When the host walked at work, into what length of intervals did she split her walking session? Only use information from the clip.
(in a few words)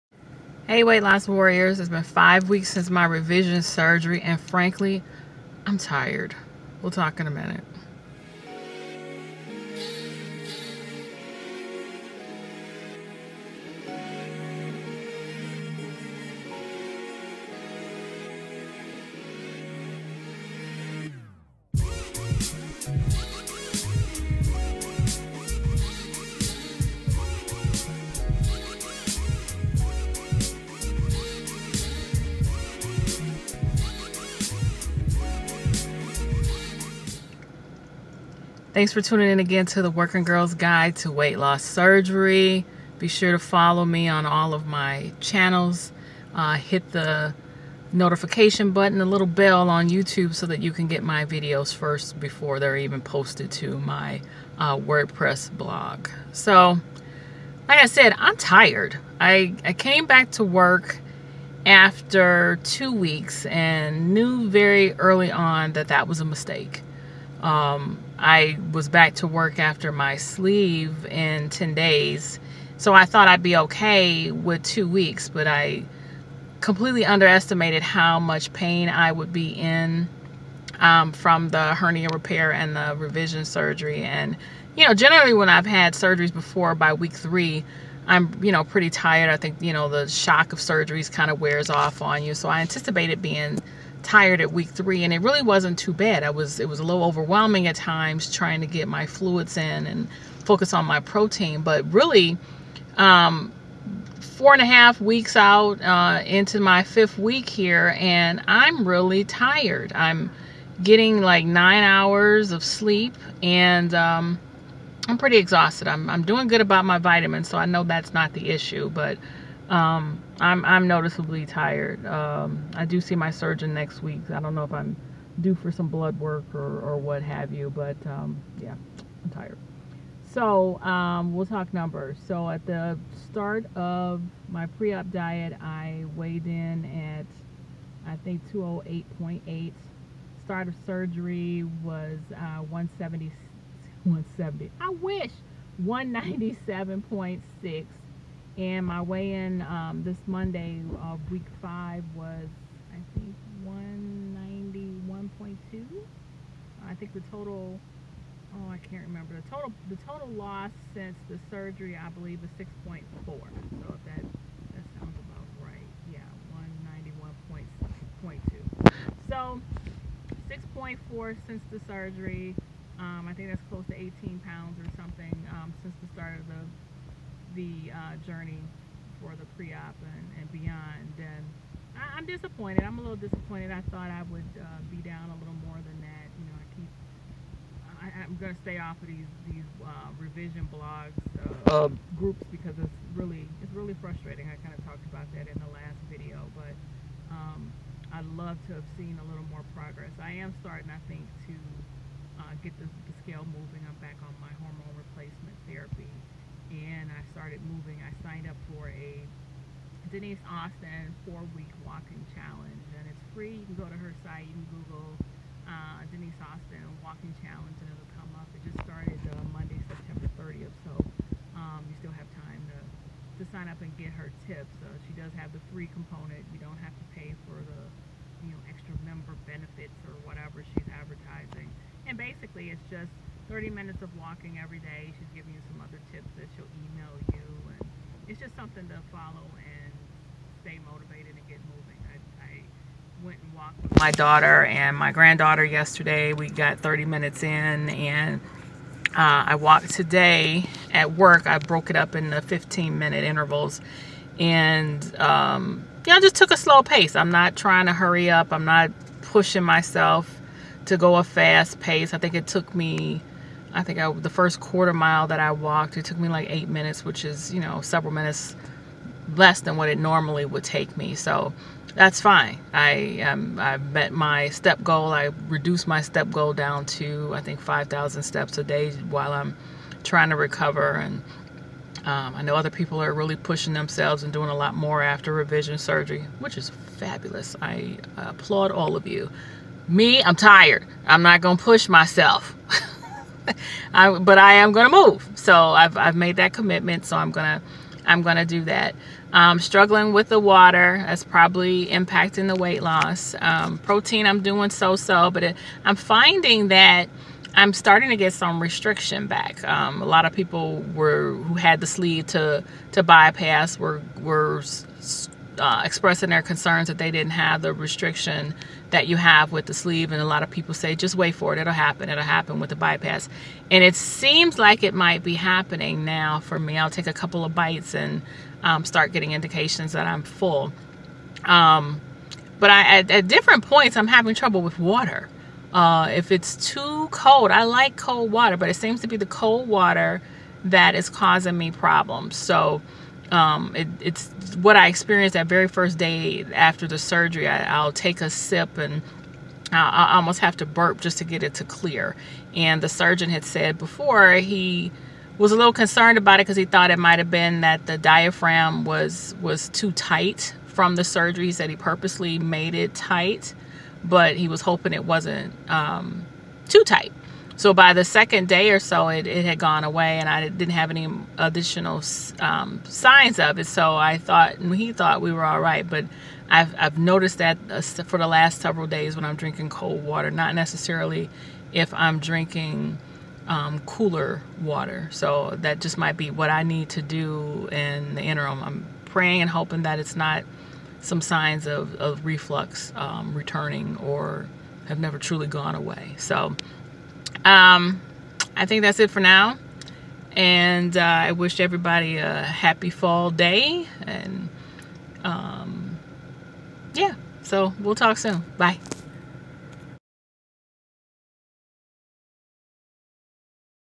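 15 minutes.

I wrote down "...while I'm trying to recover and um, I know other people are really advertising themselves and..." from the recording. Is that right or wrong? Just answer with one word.
wrong.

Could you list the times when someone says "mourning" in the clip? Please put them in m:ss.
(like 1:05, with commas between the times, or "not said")
not said.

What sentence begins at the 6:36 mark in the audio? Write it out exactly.
So um, I think that's it for now.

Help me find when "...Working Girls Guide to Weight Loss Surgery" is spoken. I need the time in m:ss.
0:39.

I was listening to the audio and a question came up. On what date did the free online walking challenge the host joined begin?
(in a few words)
Monday, September 30th.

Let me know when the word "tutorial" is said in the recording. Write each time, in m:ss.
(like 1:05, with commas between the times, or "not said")
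not said.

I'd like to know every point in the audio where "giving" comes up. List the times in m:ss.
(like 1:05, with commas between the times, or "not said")
3:55.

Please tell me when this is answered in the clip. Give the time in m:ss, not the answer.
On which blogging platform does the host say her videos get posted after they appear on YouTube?
0:54.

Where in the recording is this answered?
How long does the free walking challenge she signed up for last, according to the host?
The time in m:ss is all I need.
3:31.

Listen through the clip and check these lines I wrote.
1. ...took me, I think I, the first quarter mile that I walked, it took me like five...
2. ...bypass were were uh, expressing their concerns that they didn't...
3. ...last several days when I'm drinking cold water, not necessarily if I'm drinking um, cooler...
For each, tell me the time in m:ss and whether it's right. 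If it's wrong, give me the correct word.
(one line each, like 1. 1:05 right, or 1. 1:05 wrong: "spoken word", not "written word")
1. 4:22 wrong: "eight", not "five"
2. 5:13 right
3. 6:18 right.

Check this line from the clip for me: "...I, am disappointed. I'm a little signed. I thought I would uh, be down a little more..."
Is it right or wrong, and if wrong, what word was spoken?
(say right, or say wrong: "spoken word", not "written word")
wrong: "disappointed", not "signed".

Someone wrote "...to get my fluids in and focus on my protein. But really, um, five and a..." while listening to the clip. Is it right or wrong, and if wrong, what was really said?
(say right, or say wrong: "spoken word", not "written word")
wrong: "four", not "five".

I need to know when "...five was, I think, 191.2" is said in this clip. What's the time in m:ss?
2:31.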